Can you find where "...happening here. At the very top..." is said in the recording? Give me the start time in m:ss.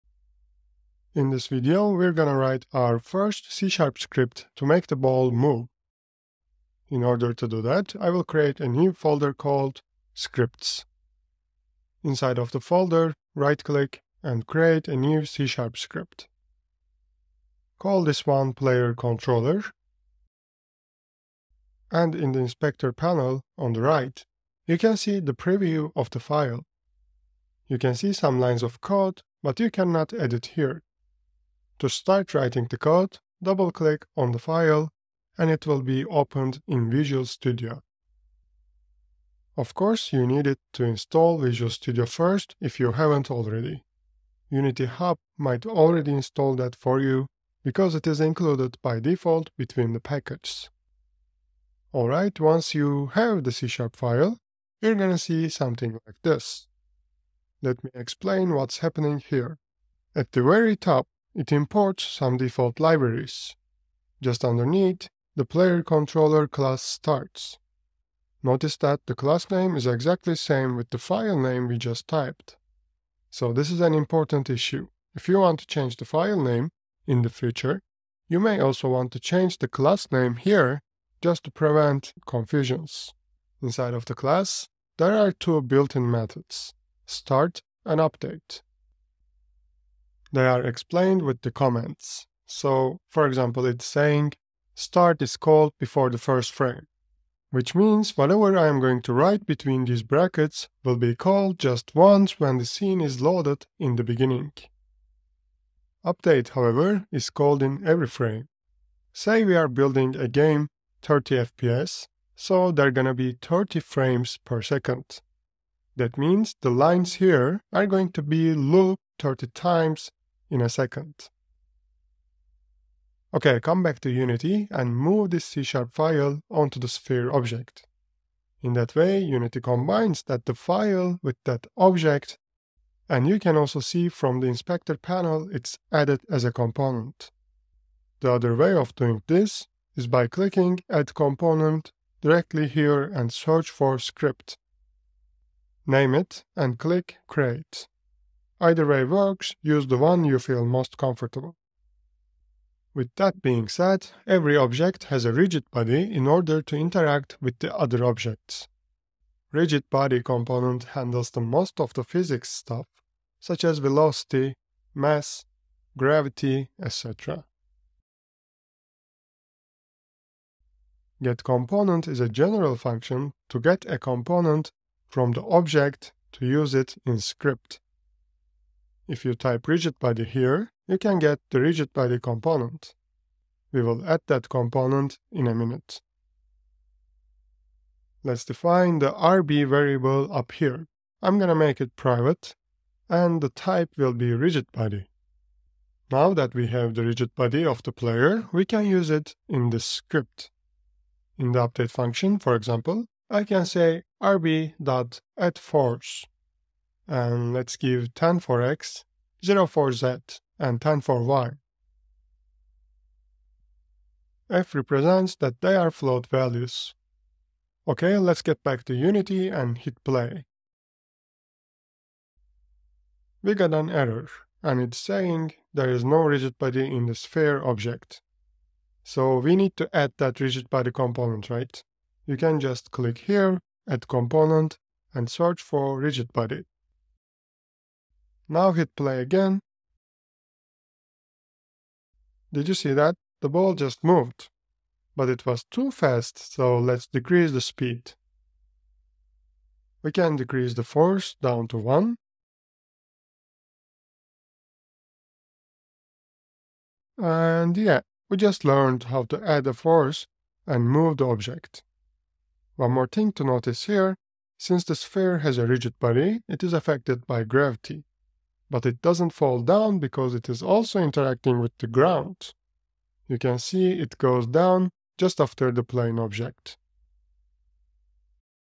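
0:58.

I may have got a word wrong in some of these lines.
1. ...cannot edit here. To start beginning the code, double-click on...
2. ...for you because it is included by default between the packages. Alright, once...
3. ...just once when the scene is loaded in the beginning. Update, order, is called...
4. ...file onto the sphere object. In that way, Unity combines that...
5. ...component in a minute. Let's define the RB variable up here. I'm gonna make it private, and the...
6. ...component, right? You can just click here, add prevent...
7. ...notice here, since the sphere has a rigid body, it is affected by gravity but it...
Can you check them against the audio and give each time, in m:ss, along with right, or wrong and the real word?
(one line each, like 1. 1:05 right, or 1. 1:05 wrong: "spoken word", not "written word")
1. 0:29 wrong: "writing", not "beginning"
2. 0:46 right
3. 1:41 wrong: "however", not "order"
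4. 2:05 right
5. 3:04 right
6. 3:50 wrong: "component", not "prevent"
7. 4:23 right.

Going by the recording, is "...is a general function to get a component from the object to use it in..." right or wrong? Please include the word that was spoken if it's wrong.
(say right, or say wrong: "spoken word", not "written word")
right.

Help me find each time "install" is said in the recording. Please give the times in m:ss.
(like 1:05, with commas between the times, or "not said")
0:40, 0:46.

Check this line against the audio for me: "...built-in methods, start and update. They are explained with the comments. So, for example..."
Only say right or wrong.
right.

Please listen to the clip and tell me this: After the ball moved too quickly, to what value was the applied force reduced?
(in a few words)
1.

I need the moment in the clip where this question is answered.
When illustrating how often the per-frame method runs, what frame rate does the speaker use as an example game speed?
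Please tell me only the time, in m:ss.
1:51.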